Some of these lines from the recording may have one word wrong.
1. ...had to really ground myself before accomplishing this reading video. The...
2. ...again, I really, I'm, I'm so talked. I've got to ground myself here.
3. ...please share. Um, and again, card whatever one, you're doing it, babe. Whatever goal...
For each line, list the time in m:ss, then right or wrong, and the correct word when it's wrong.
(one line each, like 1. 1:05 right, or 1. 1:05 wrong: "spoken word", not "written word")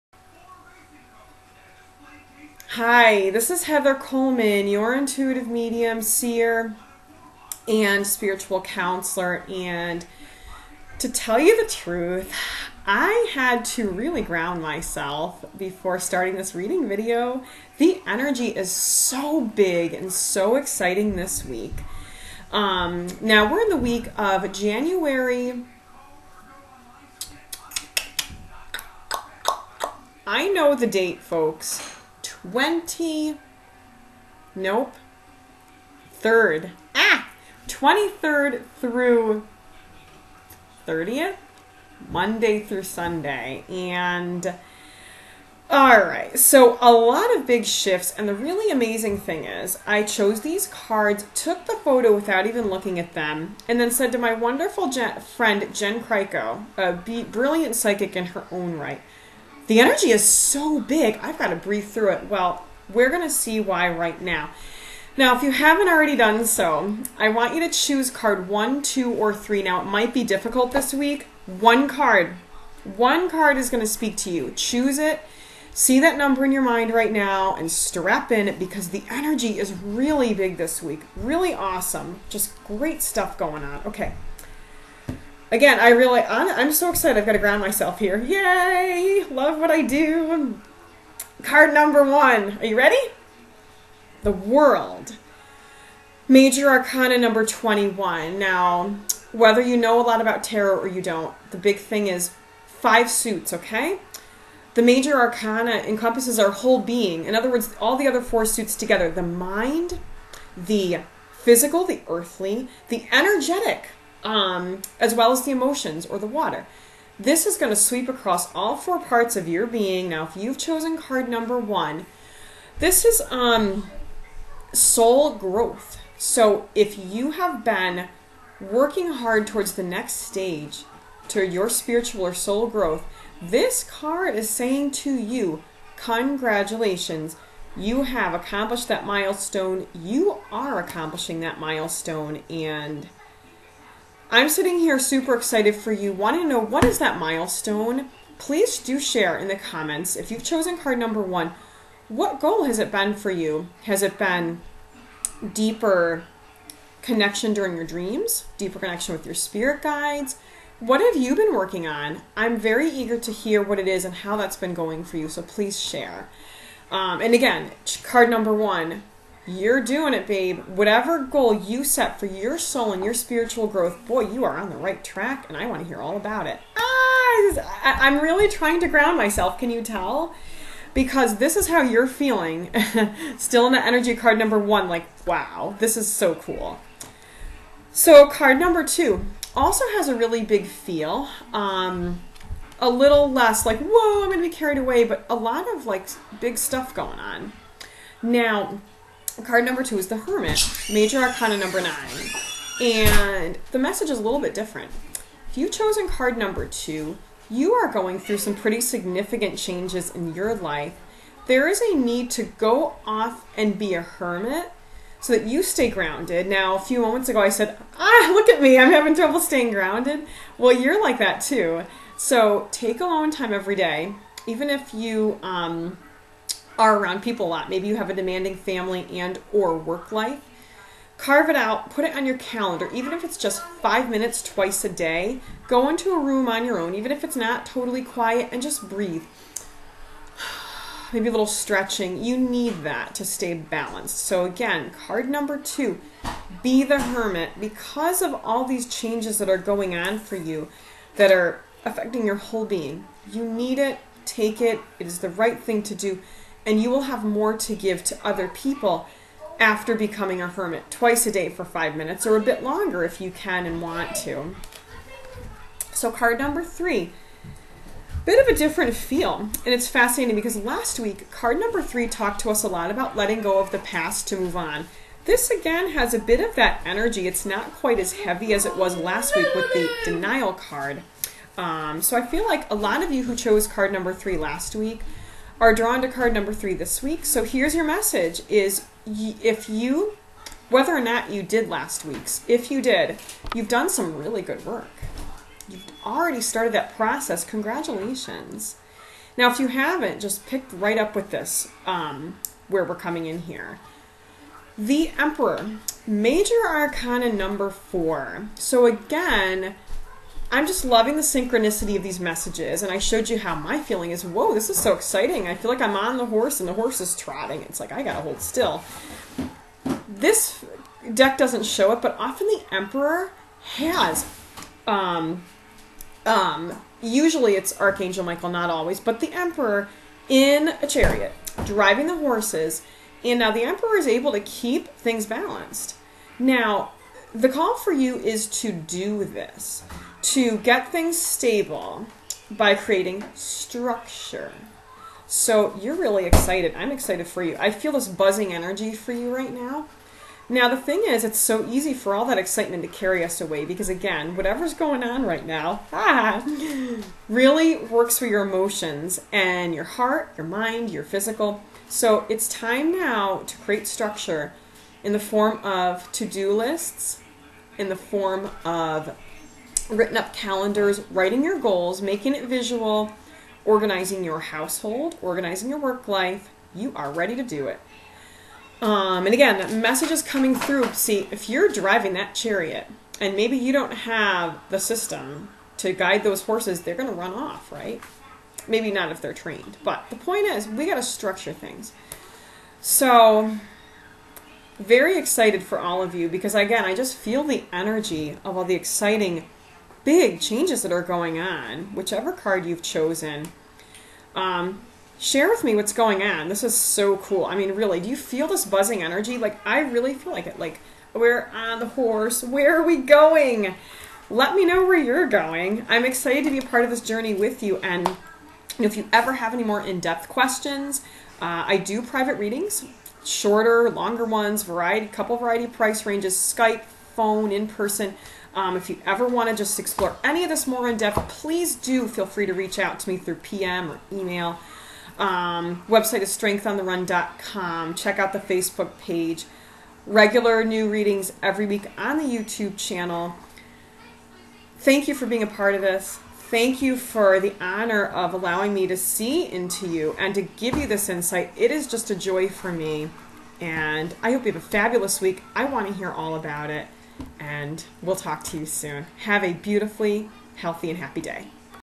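1. 0:13 wrong: "starting", not "accomplishing"
2. 1:25 wrong: "excited", not "talked"
3. 2:45 wrong: "number", not "whatever".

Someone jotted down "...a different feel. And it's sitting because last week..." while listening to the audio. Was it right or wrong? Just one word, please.
wrong.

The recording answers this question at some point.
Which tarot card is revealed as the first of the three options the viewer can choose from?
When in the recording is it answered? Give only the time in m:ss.
1:34.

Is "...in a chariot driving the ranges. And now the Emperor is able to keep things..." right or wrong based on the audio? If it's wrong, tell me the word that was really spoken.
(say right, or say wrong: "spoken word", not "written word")
wrong: "horses", not "ranges".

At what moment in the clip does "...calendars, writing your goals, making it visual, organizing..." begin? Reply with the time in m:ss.
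6:10.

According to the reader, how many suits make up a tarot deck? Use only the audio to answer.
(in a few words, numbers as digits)
5.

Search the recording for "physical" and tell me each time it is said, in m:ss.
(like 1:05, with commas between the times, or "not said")
1:51, 6:01.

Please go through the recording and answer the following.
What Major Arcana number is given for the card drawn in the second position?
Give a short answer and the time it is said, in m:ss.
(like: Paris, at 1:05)
9, at 3:20.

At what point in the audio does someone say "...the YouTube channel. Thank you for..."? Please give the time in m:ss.
7:22.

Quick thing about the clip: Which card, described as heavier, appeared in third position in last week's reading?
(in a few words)
the denial card.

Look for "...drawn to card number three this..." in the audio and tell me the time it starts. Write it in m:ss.
4:45.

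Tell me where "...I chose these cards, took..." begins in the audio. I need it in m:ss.
0:49.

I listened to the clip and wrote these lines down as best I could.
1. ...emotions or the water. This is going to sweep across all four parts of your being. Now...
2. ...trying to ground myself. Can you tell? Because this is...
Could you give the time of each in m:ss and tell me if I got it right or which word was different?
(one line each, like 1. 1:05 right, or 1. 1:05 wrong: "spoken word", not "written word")
1. 1:55 right
2. 2:58 right.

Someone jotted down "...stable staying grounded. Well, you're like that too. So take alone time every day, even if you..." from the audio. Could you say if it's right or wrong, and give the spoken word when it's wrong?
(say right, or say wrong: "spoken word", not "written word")
wrong: "trouble", not "stable".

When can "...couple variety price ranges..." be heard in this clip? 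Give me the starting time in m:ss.
7:05.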